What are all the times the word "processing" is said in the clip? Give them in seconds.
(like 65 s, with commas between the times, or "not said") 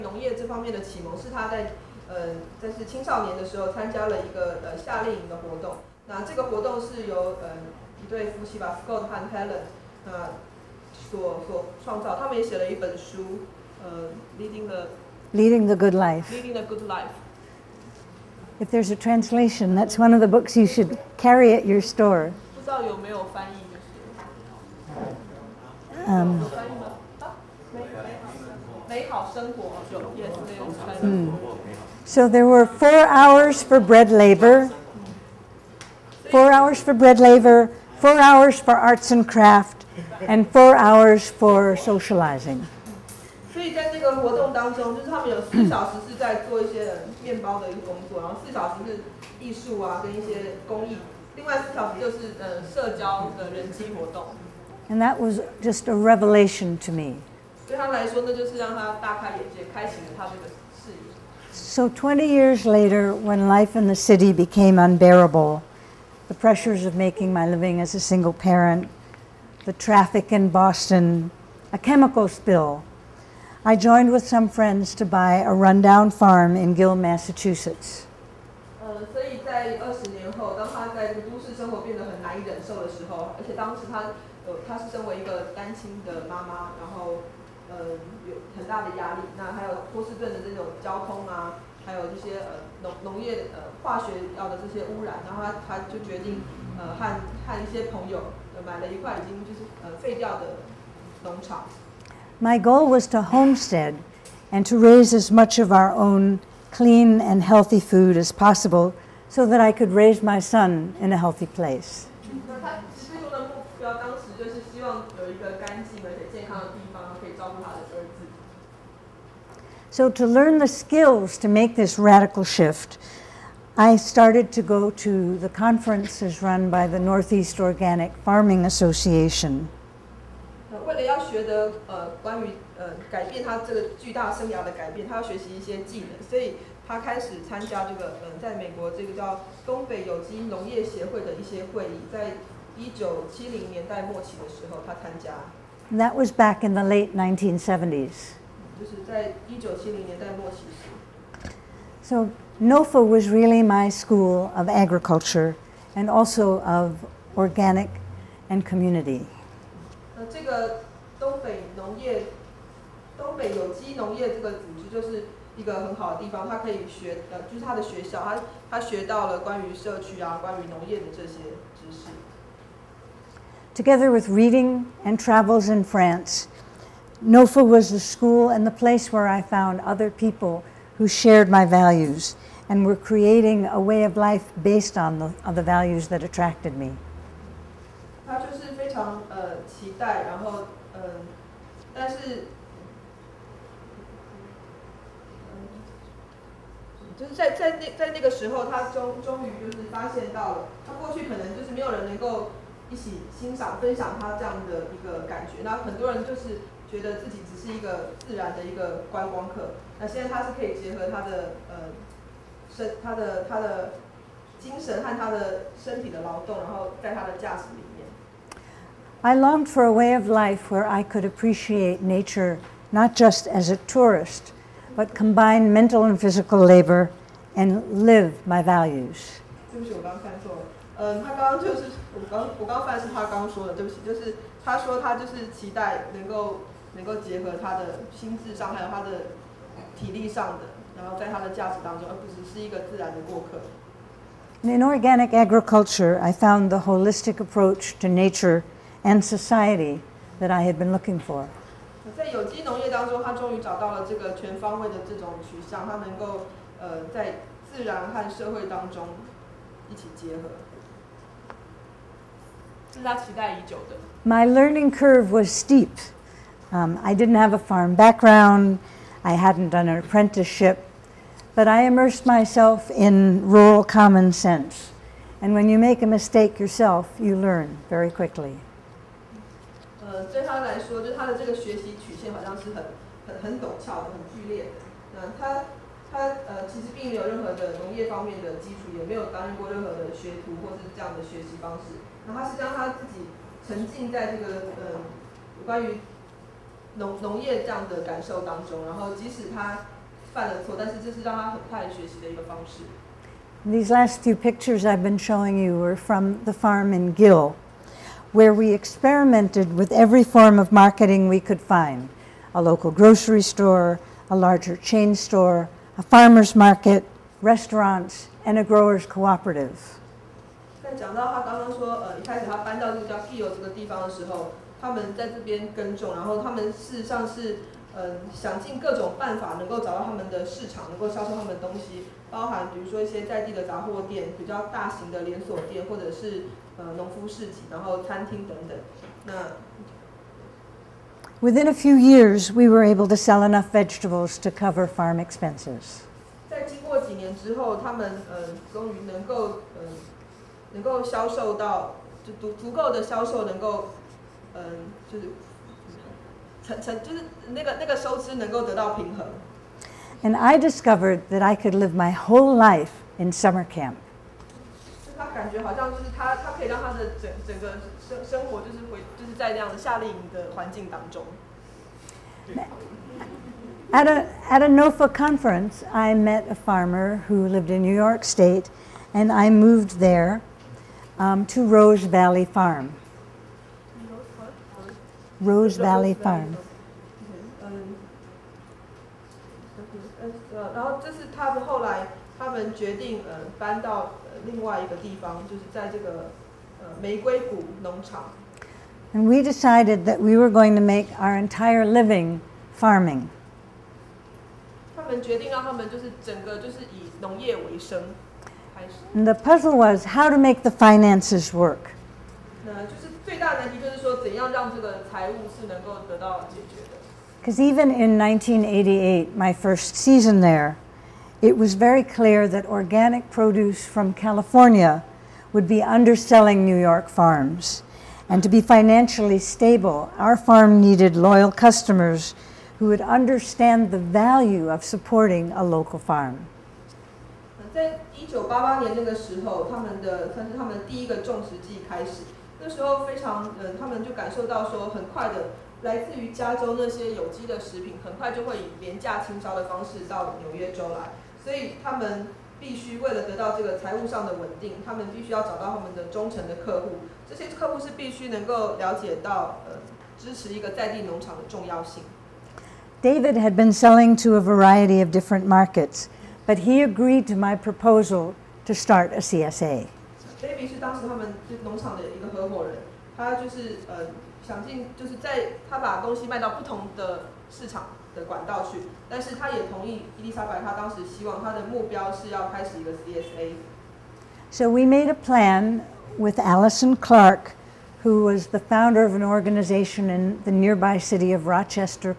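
not said.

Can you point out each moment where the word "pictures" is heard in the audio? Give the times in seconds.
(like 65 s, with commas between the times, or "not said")
304 s.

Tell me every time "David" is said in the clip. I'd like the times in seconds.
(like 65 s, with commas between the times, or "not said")
463 s, 470 s.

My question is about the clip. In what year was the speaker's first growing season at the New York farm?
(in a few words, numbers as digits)
1988.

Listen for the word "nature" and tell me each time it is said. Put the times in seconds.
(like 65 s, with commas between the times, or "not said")
222 s, 248 s.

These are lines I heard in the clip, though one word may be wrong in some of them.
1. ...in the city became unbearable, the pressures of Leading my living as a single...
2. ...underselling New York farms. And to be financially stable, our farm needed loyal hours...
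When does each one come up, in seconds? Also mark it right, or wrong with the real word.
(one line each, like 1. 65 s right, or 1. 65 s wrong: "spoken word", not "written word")
1. 63 s wrong: "making", not "Leading"
2. 425 s wrong: "customers", not "hours".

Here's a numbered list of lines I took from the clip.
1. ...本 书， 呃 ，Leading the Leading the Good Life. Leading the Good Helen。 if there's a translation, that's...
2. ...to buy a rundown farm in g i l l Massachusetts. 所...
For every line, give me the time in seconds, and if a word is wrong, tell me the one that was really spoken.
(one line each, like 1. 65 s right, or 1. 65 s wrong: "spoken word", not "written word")
1. 12 s wrong: "Life", not "Helen"
2. 74 s right.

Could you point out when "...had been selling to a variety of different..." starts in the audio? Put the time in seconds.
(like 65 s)
463 s.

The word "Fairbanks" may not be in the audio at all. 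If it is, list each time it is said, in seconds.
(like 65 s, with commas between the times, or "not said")
not said.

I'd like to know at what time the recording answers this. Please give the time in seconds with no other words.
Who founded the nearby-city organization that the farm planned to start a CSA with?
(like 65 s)
486 s.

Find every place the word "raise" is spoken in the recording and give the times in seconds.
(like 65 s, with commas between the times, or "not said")
104 s, 109 s.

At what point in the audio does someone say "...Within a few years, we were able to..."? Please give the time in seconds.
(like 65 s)
341 s.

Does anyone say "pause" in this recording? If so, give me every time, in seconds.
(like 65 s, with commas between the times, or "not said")
not said.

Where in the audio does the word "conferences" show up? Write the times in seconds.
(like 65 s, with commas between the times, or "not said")
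125 s, 375 s.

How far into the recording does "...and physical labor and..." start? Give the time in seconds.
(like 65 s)
226 s.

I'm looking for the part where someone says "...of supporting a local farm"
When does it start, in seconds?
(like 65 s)
434 s.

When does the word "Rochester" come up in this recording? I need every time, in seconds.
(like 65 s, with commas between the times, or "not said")
491 s.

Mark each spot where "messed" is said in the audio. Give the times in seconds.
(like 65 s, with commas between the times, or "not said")
not said.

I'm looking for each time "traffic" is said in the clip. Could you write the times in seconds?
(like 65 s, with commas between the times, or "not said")
69 s.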